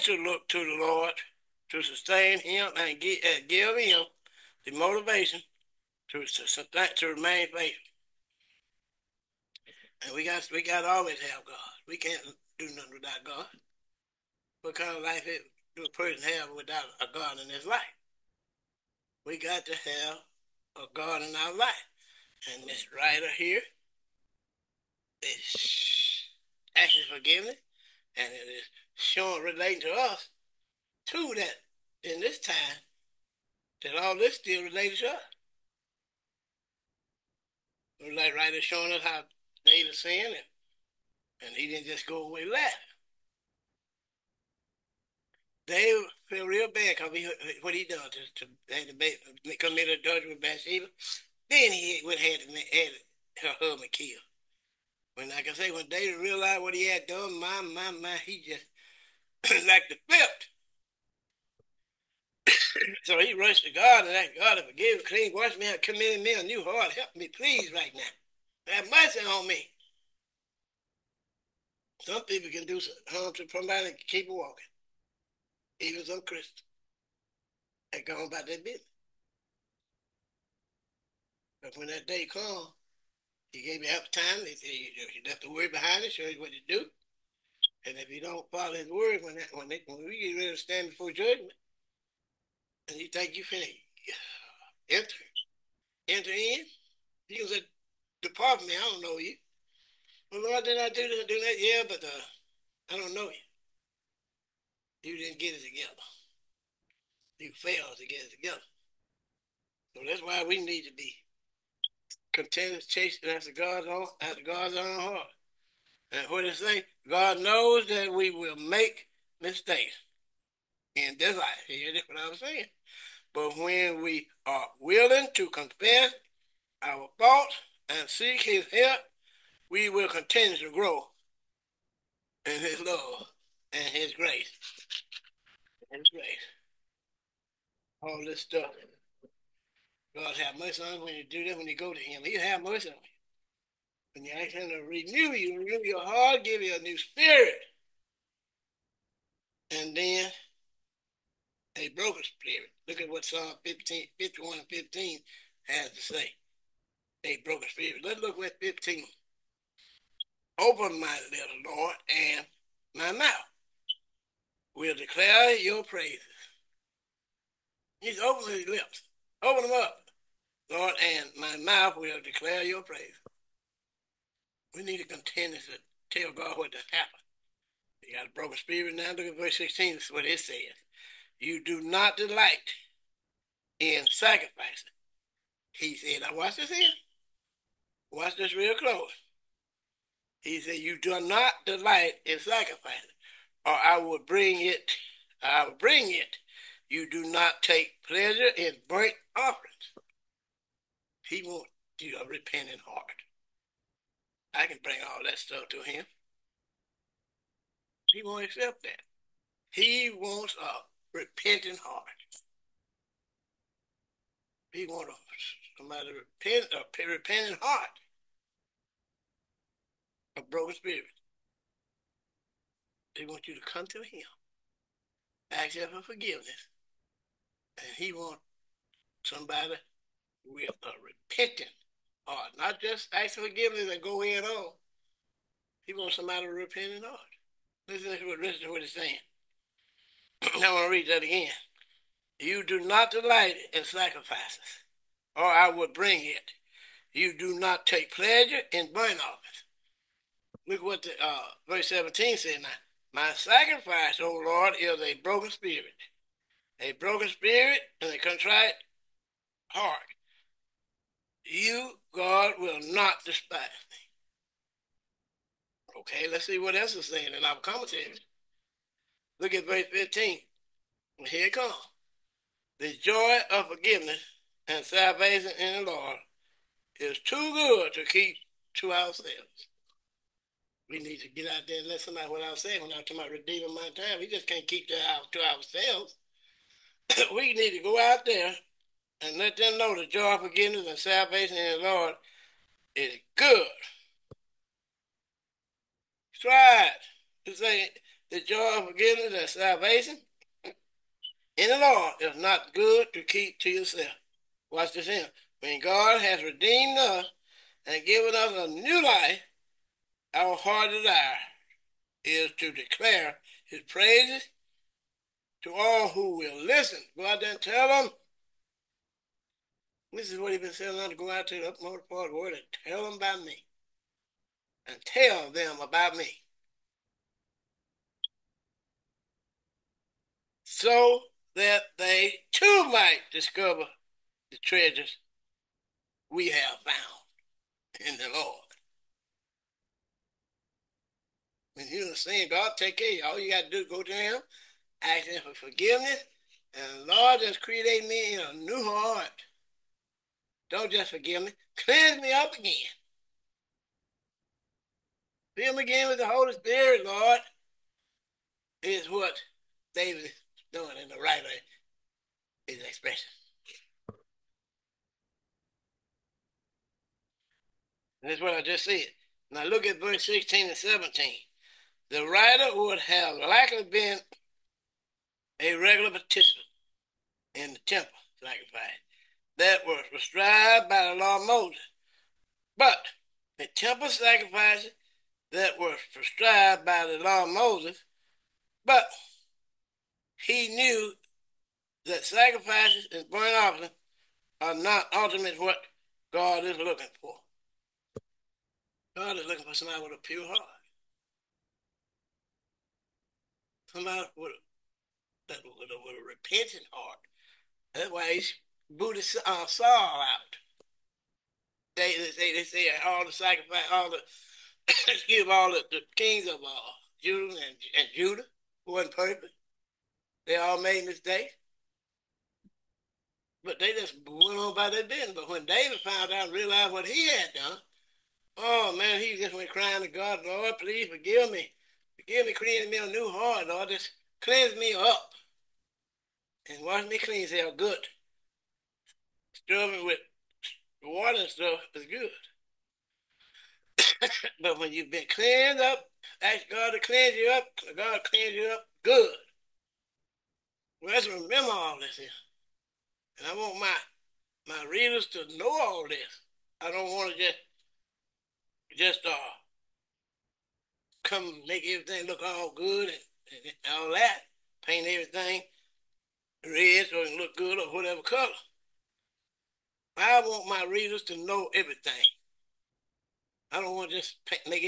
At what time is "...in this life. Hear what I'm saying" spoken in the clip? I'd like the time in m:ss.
2:00.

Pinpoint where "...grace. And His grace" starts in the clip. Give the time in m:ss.
2:14.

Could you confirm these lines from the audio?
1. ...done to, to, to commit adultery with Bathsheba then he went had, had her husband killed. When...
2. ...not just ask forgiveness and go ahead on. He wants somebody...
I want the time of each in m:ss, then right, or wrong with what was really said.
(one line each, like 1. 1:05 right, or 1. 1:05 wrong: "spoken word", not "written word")
1. 0:47 right
2. 3:52 right.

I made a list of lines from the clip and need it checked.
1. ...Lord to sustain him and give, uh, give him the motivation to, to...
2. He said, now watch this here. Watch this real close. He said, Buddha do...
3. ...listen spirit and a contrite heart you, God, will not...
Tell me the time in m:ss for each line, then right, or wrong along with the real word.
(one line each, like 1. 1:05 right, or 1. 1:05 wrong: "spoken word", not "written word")
1. 0:00 right
2. 3:05 wrong: "You", not "Buddha"
3. 4:16 wrong: "broken", not "listen".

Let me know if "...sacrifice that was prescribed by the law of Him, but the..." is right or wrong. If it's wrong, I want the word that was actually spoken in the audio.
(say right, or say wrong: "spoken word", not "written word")
wrong: "Moses", not "Him".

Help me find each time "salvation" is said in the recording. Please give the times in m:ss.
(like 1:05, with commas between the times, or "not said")
4:34, 4:50, 4:59.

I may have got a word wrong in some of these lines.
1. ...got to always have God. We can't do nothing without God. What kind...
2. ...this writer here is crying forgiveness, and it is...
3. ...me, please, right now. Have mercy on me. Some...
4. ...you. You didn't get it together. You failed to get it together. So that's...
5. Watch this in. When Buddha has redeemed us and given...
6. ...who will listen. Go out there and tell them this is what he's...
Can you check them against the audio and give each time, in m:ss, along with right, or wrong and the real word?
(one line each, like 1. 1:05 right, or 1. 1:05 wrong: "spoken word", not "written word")
1. 0:10 right
2. 0:22 wrong: "asking", not "crying"
3. 1:07 right
4. 1:43 right
5. 5:04 wrong: "God", not "Buddha"
6. 5:16 right.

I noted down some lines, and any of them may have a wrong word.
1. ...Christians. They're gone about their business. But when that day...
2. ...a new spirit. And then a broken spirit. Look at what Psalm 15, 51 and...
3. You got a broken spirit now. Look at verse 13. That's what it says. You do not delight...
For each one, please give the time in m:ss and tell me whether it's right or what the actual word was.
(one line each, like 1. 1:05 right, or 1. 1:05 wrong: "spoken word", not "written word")
1. 1:16 right
2. 2:26 right
3. 2:58 wrong: "16", not "13".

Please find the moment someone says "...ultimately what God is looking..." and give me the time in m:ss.
6:35.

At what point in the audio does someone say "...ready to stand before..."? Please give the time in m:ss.
1:30.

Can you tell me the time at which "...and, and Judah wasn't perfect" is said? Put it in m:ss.
6:57.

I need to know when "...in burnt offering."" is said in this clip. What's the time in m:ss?
3:18.